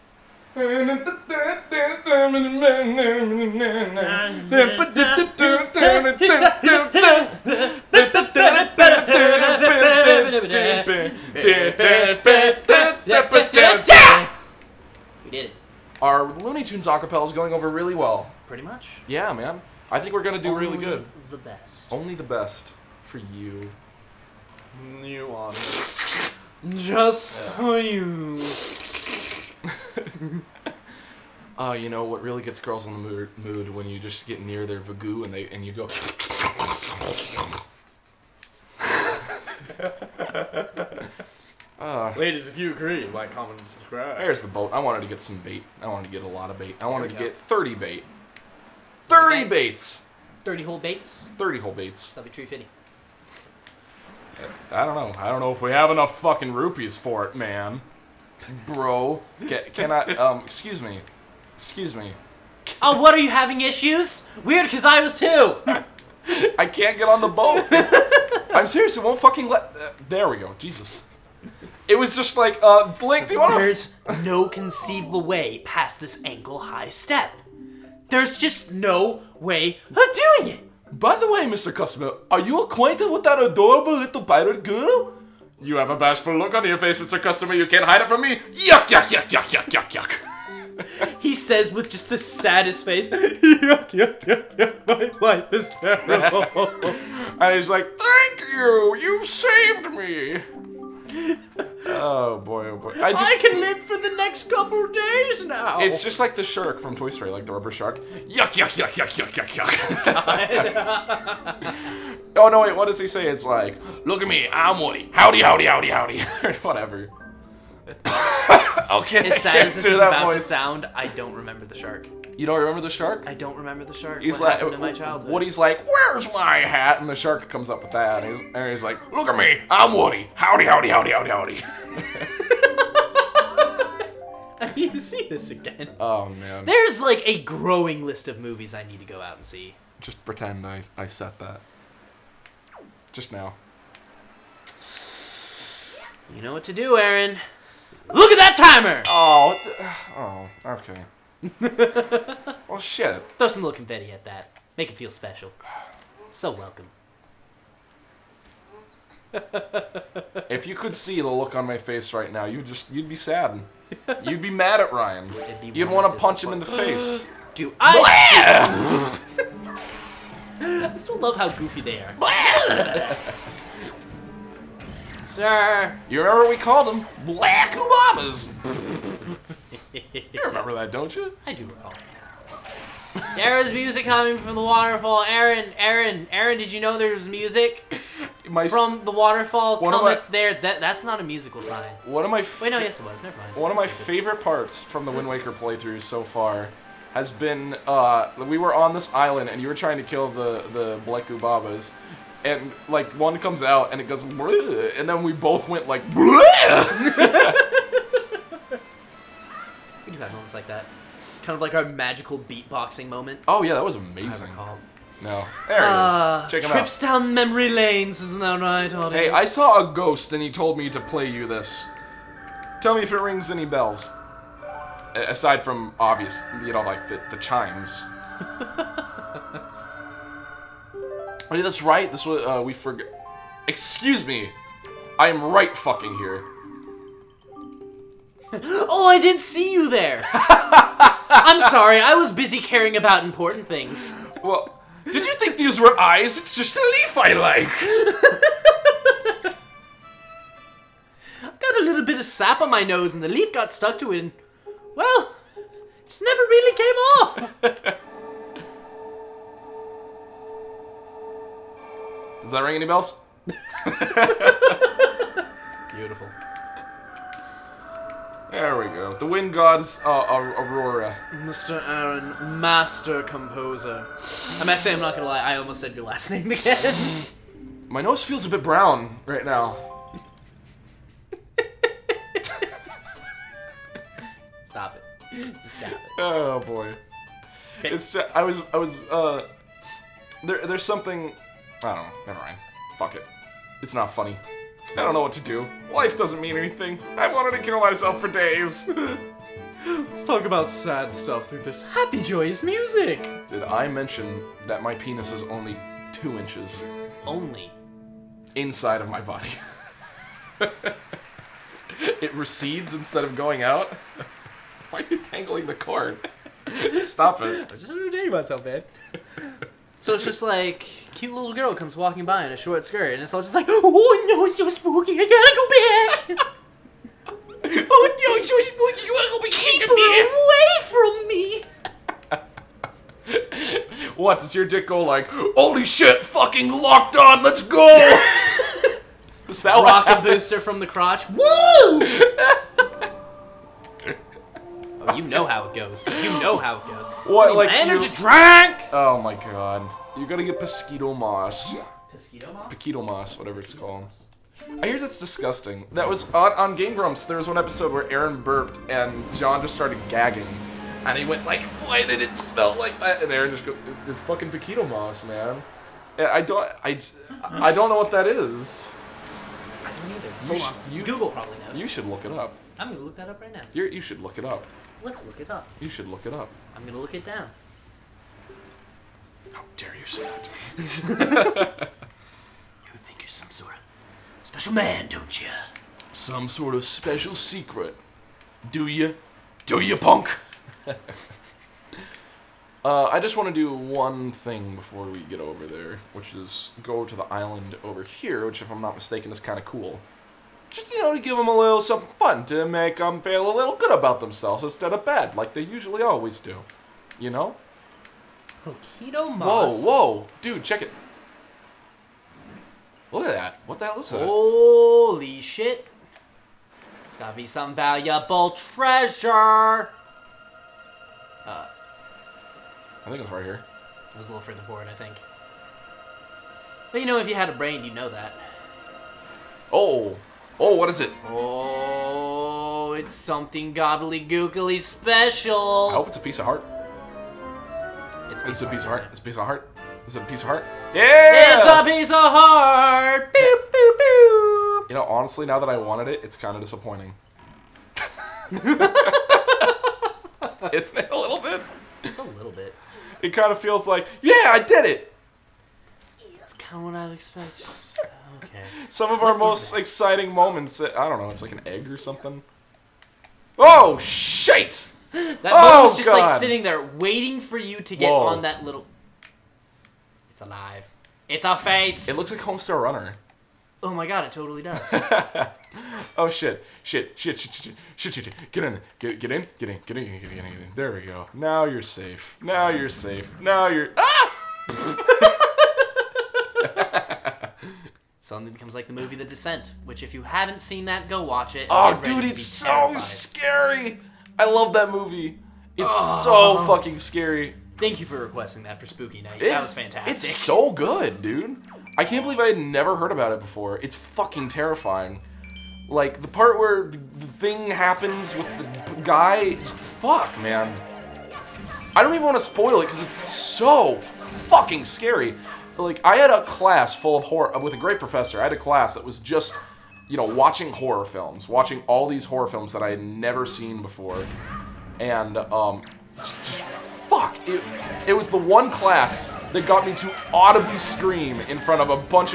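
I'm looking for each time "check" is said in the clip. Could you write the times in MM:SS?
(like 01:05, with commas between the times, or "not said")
03:36, 06:50.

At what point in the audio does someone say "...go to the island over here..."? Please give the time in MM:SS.
06:36.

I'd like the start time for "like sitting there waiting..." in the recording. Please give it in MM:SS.
07:46.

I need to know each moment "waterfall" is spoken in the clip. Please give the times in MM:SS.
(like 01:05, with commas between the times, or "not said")
03:04, 03:09.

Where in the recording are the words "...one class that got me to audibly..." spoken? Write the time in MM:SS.
08:48.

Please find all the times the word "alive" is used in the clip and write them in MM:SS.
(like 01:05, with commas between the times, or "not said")
07:50.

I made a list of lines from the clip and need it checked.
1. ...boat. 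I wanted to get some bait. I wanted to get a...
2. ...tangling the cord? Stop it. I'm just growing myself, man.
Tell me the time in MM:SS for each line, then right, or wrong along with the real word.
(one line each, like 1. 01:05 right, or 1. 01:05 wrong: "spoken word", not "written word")
1. 00:44 right
2. 05:15 wrong: "entertaining", not "growing".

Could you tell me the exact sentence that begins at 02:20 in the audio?
Just pretend I I said that.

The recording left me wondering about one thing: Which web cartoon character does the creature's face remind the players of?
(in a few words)
Homestar Runner.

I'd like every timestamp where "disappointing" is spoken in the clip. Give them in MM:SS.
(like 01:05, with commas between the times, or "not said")
07:26.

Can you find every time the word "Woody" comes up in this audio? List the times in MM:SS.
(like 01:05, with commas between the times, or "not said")
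01:54, 02:05, 02:09.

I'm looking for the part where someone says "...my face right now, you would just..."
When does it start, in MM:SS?
02:41.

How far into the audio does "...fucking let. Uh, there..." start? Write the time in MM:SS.
01:09.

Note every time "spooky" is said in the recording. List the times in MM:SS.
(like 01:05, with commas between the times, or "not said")
05:24, 05:28, 08:18.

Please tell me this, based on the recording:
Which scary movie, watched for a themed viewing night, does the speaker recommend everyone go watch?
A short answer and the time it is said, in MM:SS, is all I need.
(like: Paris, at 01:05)
The Descent, at 08:09.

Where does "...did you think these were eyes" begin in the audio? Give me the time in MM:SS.
04:05.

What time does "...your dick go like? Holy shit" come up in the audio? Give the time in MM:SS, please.
05:34.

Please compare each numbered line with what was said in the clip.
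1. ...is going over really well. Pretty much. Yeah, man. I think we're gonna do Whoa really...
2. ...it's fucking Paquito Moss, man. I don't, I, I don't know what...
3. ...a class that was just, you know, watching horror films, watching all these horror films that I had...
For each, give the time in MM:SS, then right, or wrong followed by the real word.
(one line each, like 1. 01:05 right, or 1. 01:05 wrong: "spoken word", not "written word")
1. 00:17 wrong: "Only", not "Whoa"
2. 06:04 right
3. 08:38 right.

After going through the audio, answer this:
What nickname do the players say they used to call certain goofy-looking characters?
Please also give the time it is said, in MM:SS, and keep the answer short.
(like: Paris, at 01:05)
Black Obamas, at 02:57.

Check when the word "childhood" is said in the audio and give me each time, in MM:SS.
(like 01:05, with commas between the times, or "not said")
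02:04.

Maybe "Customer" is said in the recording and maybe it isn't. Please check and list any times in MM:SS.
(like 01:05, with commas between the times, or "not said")
01:21, 01:27.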